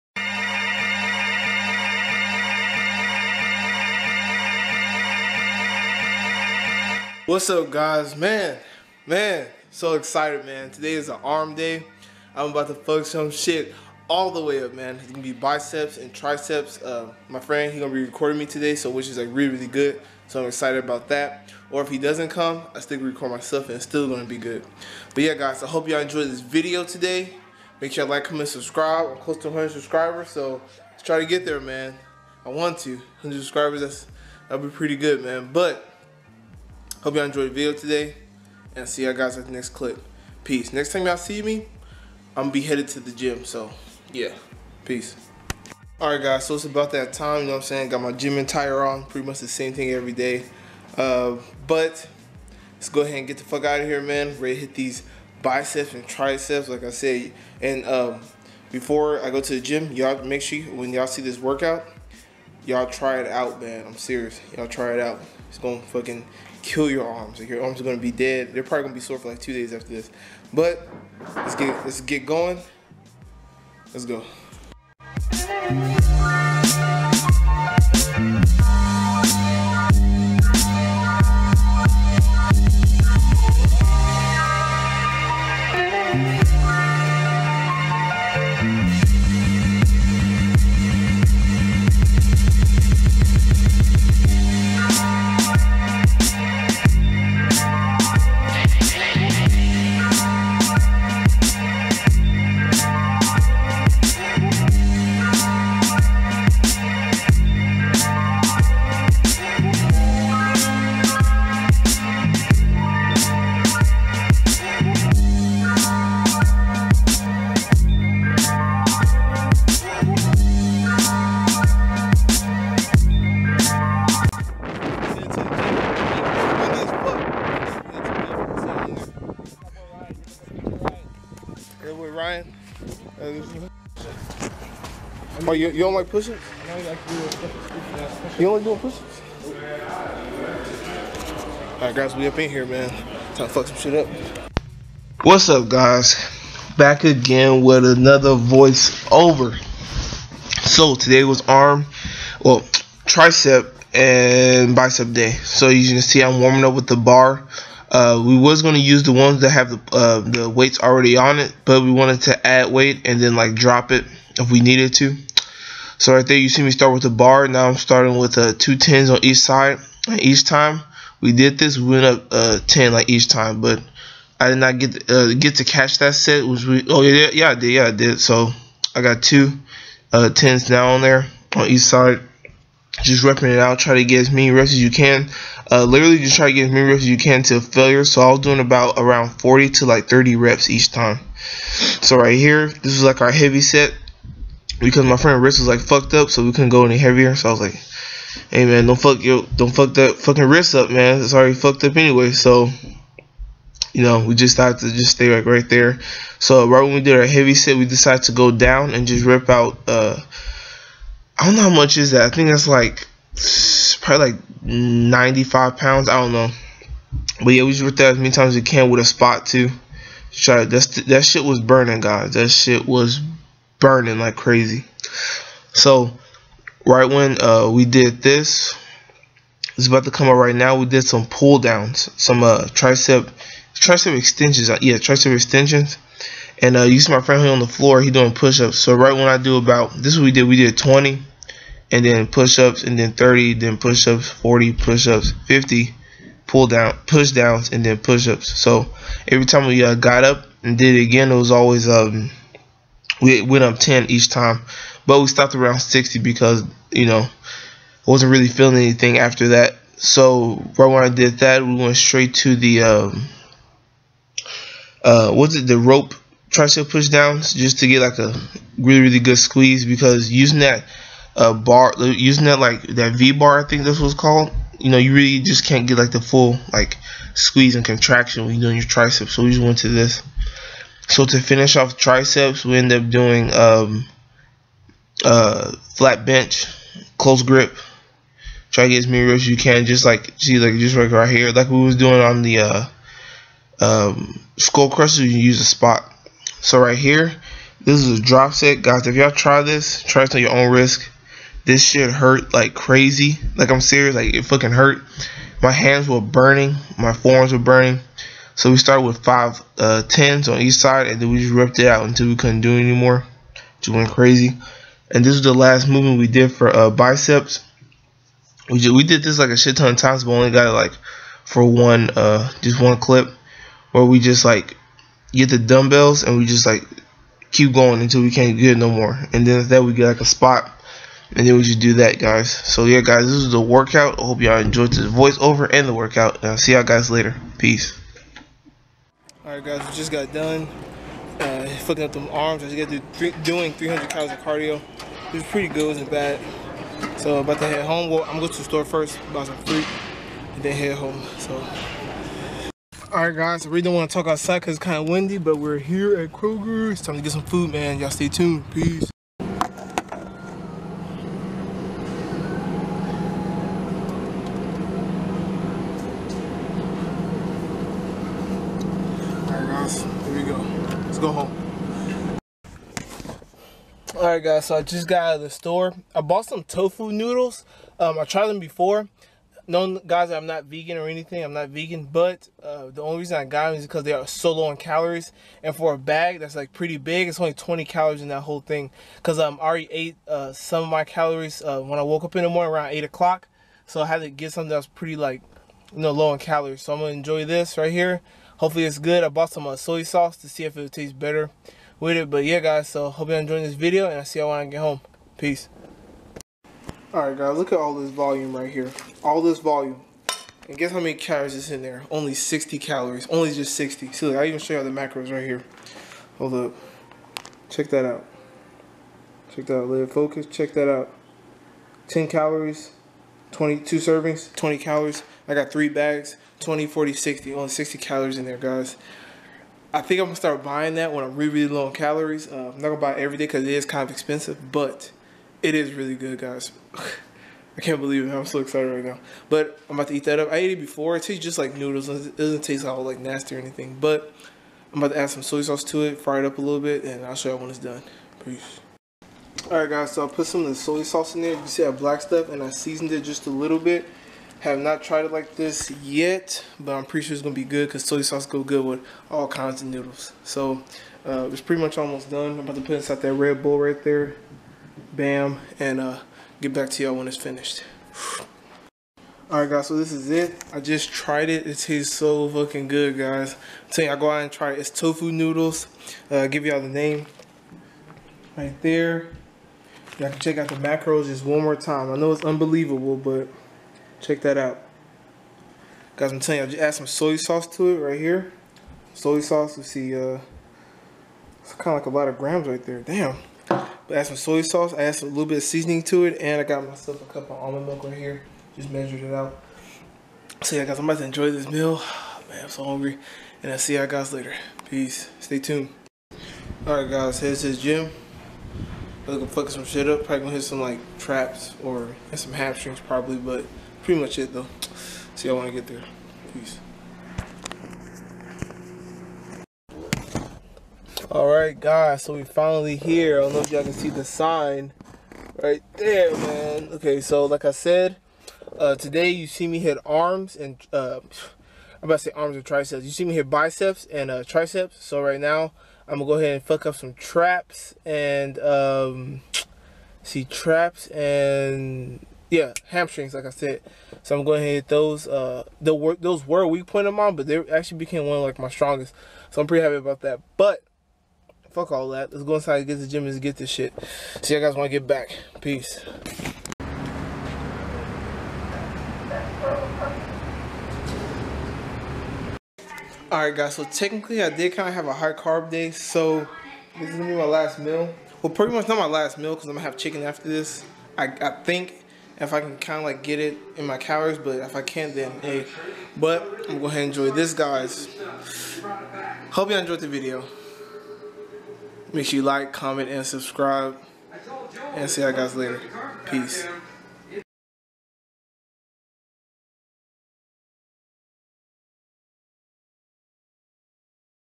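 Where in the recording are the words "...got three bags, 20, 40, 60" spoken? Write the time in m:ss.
7:05.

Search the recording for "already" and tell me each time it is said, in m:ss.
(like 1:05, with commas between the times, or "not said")
2:40, 3:21, 6:29.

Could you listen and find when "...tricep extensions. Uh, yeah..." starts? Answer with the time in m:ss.
3:53.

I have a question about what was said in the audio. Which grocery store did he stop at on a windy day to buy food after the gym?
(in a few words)
Kroger.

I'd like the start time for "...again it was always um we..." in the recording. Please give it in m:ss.
4:11.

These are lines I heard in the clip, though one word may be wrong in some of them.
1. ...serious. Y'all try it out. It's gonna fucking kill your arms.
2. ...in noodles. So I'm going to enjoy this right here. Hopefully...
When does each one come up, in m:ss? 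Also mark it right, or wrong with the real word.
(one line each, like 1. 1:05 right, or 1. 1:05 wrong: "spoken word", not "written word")
1. 1:03 right
2. 6:36 wrong: "calories", not "noodles".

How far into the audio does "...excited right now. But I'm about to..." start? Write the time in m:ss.
7:18.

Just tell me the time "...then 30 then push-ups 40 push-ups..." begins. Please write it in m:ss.
4:02.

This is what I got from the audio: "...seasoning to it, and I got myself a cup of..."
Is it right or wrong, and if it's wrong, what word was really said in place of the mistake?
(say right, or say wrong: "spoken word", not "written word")
right.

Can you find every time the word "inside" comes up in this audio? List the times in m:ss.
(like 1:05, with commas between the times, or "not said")
7:42, 9:12.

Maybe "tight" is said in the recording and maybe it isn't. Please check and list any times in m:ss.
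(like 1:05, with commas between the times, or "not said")
not said.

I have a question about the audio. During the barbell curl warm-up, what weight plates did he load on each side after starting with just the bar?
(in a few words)
two tens.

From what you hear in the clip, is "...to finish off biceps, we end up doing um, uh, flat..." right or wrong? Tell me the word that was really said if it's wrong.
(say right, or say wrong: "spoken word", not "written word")
wrong: "triceps", not "biceps".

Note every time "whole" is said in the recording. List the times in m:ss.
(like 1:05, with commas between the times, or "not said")
6:28.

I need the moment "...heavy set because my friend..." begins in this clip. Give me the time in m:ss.
3:13.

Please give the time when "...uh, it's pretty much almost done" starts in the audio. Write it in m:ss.
7:41.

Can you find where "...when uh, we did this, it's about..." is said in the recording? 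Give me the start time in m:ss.
3:47.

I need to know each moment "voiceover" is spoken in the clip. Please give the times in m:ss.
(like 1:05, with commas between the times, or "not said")
2:28, 5:35.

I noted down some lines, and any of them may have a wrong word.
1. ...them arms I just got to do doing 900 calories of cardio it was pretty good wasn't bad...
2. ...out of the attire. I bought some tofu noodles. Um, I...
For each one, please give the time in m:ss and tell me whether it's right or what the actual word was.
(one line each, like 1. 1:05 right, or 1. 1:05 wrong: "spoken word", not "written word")
1. 5:42 wrong: "300", not "900"
2. 6:15 wrong: "store", not "attire".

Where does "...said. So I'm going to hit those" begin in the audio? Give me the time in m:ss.
9:03.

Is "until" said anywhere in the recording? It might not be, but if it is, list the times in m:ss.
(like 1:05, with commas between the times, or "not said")
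5:12, 5:28.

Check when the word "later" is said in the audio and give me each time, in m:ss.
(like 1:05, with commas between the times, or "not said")
5:37, 8:24, 9:45.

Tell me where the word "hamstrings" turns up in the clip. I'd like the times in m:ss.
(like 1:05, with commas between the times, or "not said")
8:32, 9:02.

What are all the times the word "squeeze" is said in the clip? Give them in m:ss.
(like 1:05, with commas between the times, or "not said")
4:29, 4:37.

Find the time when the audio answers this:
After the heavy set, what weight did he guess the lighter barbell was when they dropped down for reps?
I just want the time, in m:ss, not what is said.
3:34.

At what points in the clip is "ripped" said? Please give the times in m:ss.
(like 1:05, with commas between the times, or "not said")
3:37, 5:11.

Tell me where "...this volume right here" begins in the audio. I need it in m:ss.
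6:47.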